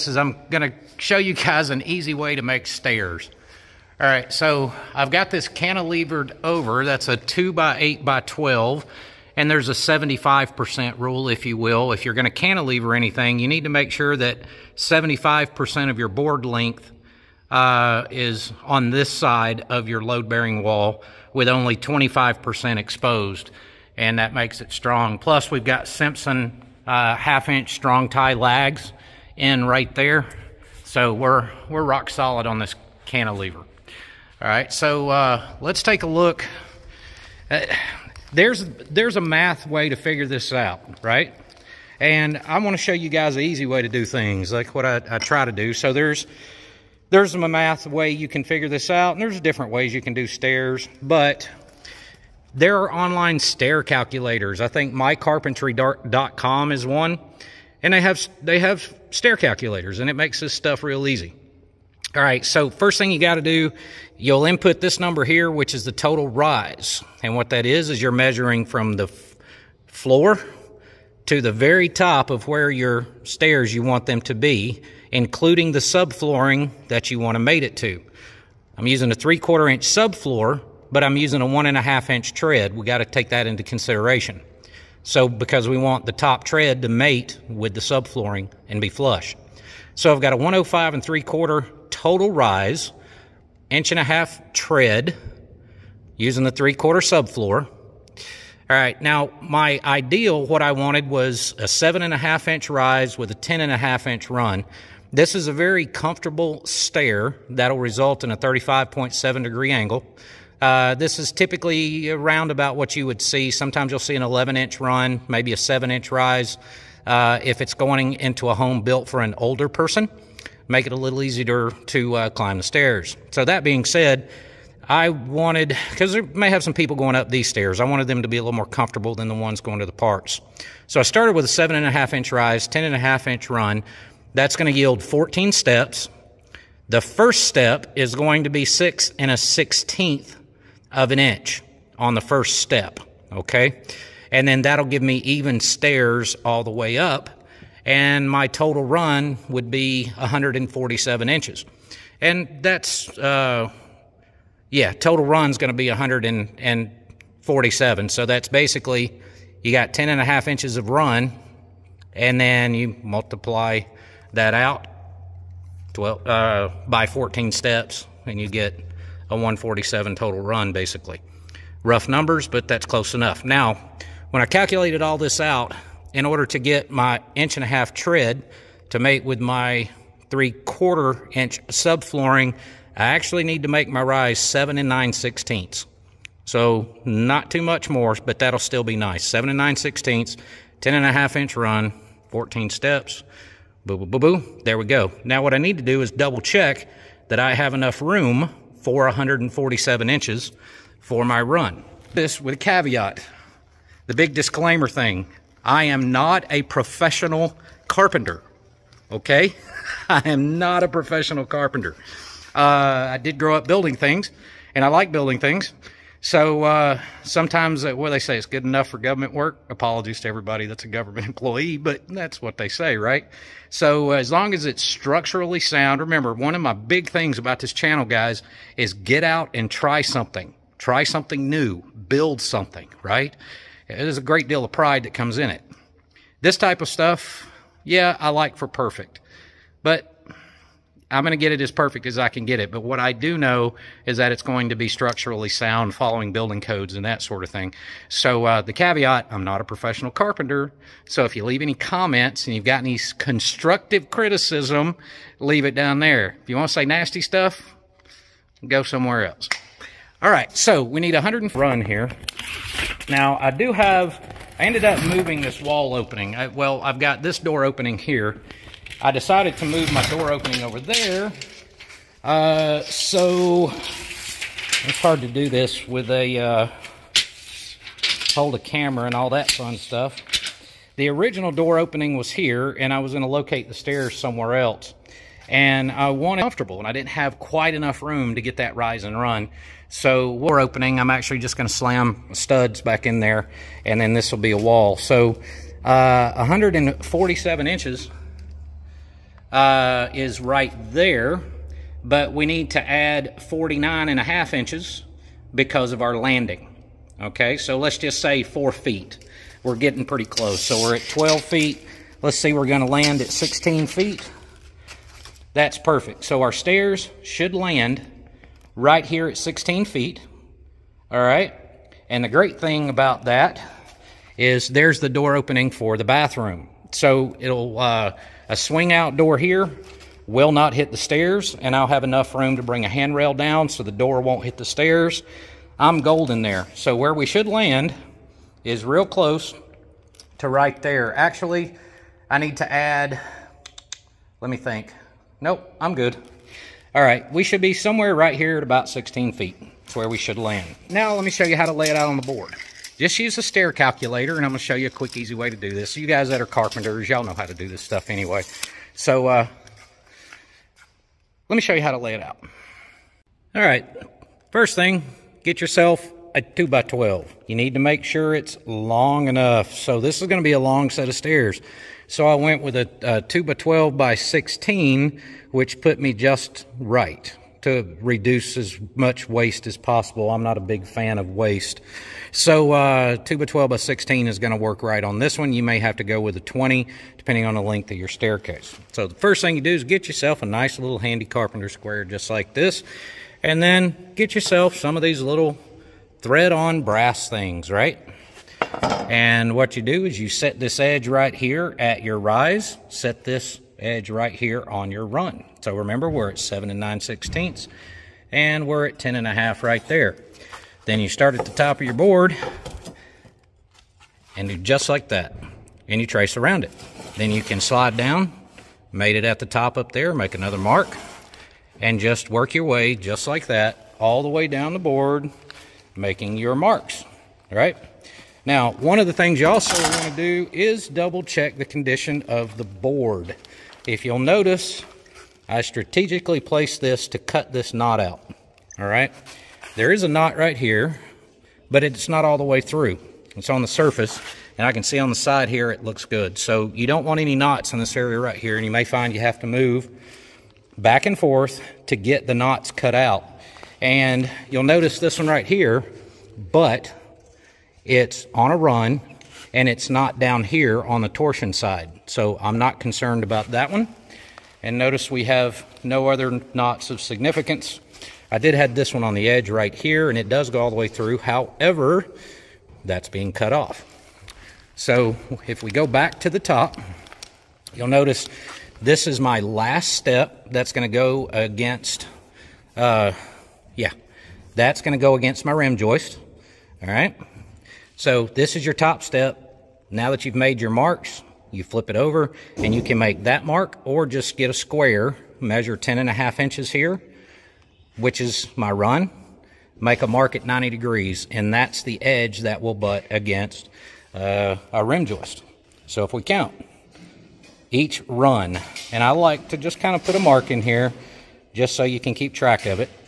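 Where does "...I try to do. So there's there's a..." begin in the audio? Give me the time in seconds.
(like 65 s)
45 s.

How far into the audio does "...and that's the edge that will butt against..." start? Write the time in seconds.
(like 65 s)
501 s.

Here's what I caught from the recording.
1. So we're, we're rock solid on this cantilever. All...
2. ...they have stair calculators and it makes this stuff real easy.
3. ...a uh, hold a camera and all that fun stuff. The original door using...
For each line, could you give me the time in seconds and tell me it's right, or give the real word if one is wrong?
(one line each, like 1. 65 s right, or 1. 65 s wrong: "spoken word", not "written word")
1. 30 s right
2. 58 s right
3. 276 s wrong: "opening", not "using".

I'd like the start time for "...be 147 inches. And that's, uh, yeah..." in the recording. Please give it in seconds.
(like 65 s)
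149 s.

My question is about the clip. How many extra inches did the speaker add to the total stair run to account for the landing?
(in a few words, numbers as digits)
49 1/2.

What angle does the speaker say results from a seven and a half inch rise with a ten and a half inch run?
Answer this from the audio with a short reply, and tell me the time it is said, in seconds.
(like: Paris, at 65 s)
35.7 degrees, at 108 s.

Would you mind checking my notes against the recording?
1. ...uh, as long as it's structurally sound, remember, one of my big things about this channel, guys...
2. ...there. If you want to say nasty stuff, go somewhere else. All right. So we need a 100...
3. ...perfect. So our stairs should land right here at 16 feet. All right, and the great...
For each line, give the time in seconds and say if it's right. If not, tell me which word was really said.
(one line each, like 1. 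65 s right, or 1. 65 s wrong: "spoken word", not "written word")
1. 224 s right
2. 255 s right
3. 315 s right.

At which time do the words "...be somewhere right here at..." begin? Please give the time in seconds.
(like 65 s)
347 s.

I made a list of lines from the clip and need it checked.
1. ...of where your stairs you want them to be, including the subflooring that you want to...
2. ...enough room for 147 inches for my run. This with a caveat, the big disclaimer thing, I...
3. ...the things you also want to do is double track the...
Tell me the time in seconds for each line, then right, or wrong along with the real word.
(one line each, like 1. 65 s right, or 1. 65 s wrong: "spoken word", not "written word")
1. 72 s right
2. 197 s right
3. 429 s wrong: "check", not "track".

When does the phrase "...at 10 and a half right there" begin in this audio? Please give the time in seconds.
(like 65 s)
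408 s.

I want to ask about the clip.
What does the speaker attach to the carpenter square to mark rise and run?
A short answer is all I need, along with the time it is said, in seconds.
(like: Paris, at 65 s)
thread-on brass things, at 396 s.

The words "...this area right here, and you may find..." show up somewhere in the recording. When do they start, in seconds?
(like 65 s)
447 s.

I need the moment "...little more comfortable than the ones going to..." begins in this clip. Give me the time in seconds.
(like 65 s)
128 s.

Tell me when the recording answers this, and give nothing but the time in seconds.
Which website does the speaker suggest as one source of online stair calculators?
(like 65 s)
54 s.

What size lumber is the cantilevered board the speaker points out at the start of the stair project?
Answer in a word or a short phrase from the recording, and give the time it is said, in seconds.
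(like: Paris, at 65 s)
2 by 8 by 12, at 7 s.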